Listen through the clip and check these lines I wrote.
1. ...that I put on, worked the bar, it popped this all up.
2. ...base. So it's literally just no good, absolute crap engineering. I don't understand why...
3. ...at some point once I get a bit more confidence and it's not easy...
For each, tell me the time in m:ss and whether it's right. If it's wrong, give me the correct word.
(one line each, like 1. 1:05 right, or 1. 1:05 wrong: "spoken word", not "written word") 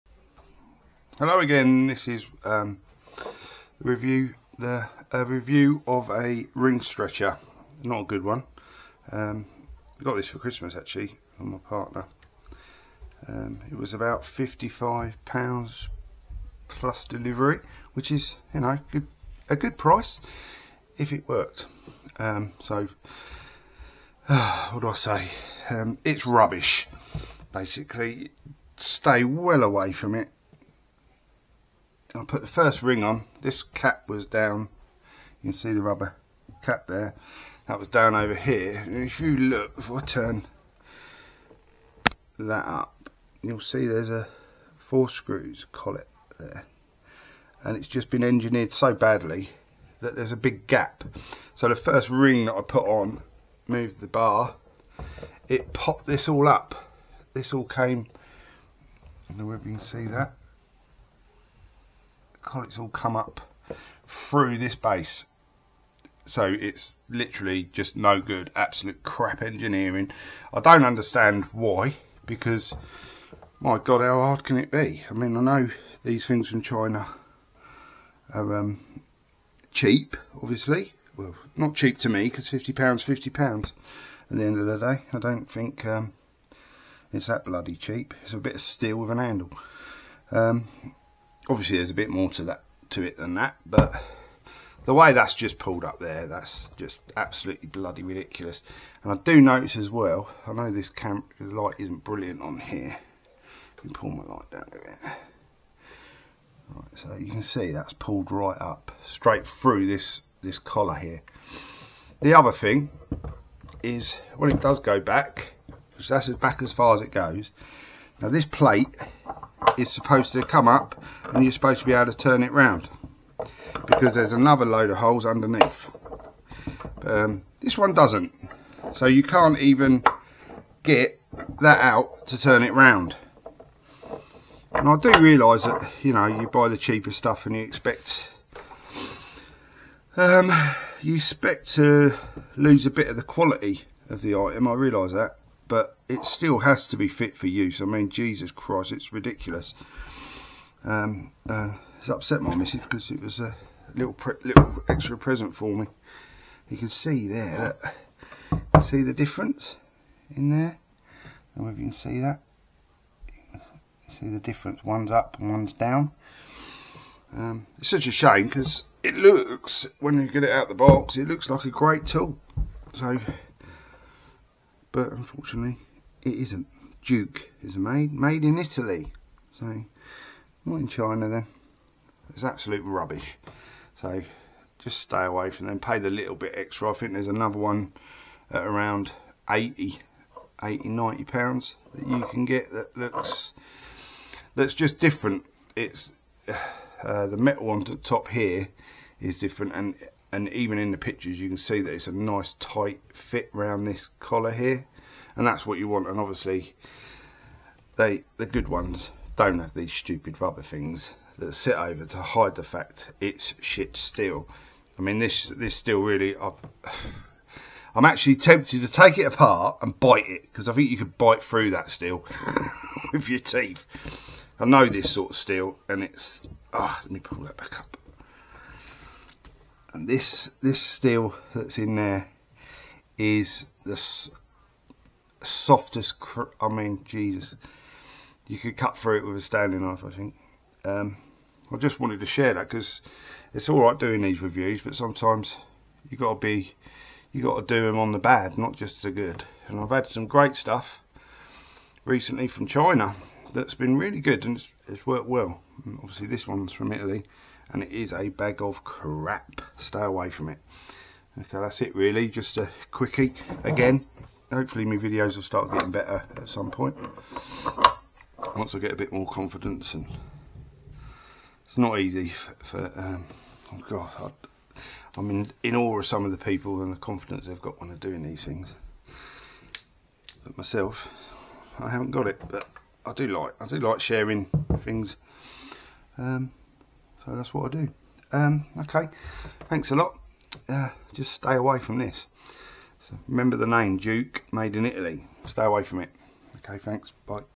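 1. 0:52 wrong: "moved", not "worked"
2. 1:04 right
3. 4:26 right.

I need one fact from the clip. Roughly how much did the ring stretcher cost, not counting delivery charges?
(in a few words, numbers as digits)
£55.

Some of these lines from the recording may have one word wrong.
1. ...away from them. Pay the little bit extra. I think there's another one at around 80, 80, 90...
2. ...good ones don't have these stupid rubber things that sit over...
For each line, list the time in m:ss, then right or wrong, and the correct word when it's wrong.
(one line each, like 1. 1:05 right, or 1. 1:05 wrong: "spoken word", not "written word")
1. 3:05 right
2. 3:28 right.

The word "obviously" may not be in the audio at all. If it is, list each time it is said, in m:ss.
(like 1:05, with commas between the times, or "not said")
1:20, 1:31, 3:26, 4:16.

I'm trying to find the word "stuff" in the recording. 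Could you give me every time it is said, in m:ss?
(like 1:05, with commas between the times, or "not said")
2:17, 4:10.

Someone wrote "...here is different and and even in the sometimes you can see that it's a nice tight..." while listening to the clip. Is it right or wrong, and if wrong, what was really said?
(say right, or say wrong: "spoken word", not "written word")
wrong: "pictures", not "sometimes".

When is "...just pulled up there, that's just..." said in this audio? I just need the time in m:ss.
1:35.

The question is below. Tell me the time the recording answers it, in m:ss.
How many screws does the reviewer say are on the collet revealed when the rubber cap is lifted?
0:44.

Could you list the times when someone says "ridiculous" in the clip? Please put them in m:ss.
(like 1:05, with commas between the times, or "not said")
1:38, 2:29.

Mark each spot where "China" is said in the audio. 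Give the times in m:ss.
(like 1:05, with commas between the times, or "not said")
1:16, 3:00, 4:12.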